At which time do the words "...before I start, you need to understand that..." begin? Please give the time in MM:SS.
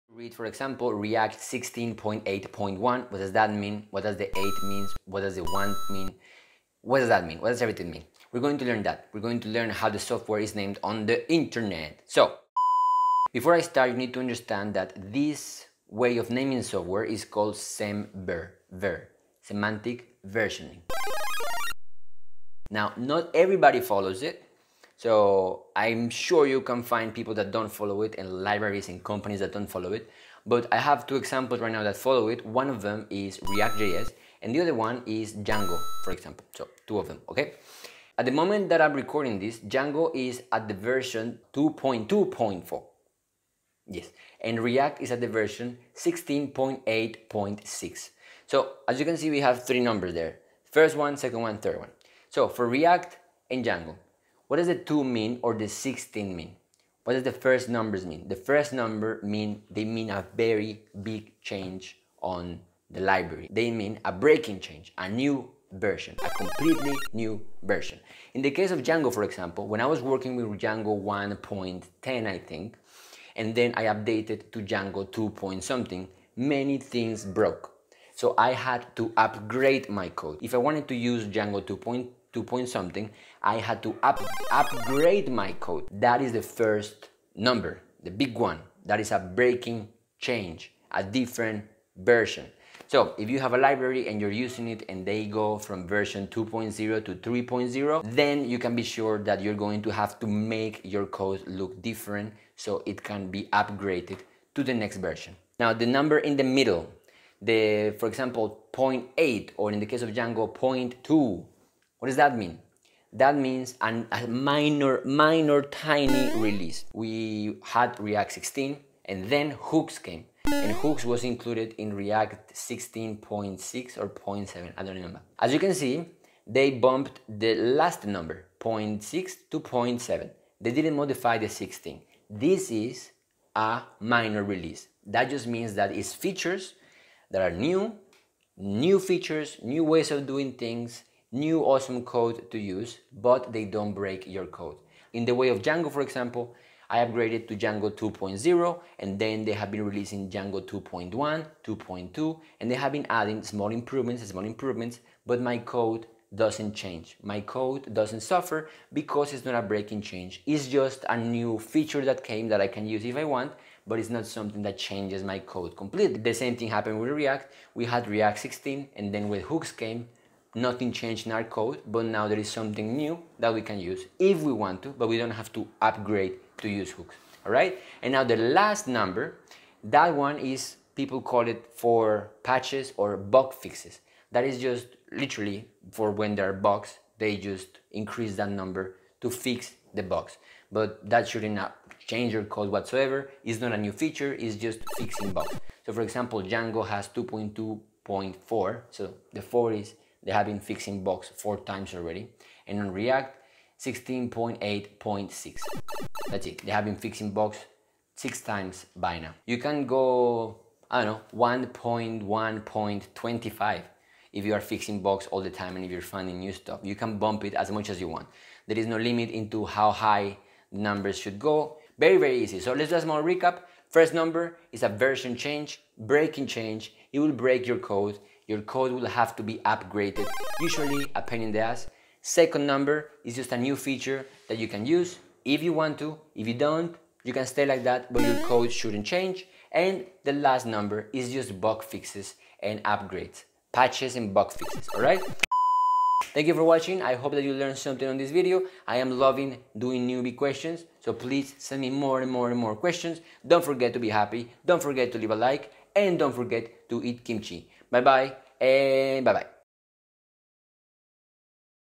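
00:13.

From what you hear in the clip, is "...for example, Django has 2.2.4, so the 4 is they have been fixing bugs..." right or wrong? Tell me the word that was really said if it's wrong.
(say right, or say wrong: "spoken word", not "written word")
right.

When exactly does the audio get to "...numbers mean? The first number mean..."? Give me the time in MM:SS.
00:57.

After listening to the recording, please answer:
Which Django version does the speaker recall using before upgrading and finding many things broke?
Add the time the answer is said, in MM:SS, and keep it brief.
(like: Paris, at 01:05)
Django 1.10, at 01:10.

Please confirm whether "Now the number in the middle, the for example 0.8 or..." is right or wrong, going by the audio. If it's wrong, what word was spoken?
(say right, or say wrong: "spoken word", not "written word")
right.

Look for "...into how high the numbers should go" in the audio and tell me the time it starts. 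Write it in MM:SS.
03:39.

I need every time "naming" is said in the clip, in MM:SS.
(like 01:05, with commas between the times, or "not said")
00:16.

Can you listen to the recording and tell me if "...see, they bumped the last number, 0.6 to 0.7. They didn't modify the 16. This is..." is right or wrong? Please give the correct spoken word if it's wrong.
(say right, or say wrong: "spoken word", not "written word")
right.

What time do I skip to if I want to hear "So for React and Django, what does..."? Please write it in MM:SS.
00:52.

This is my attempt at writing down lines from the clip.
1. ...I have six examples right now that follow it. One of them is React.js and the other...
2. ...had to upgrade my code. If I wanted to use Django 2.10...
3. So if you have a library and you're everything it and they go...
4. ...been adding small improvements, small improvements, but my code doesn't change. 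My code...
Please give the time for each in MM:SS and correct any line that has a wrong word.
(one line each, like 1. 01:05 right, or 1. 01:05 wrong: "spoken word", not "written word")
1. 00:30 wrong: "two", not "six"
2. 01:18 right
3. 01:32 wrong: "using", not "everything"
4. 02:32 right.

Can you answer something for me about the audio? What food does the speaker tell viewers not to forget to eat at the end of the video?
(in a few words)
Kimchi.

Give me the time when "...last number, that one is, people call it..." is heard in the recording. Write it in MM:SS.
02:58.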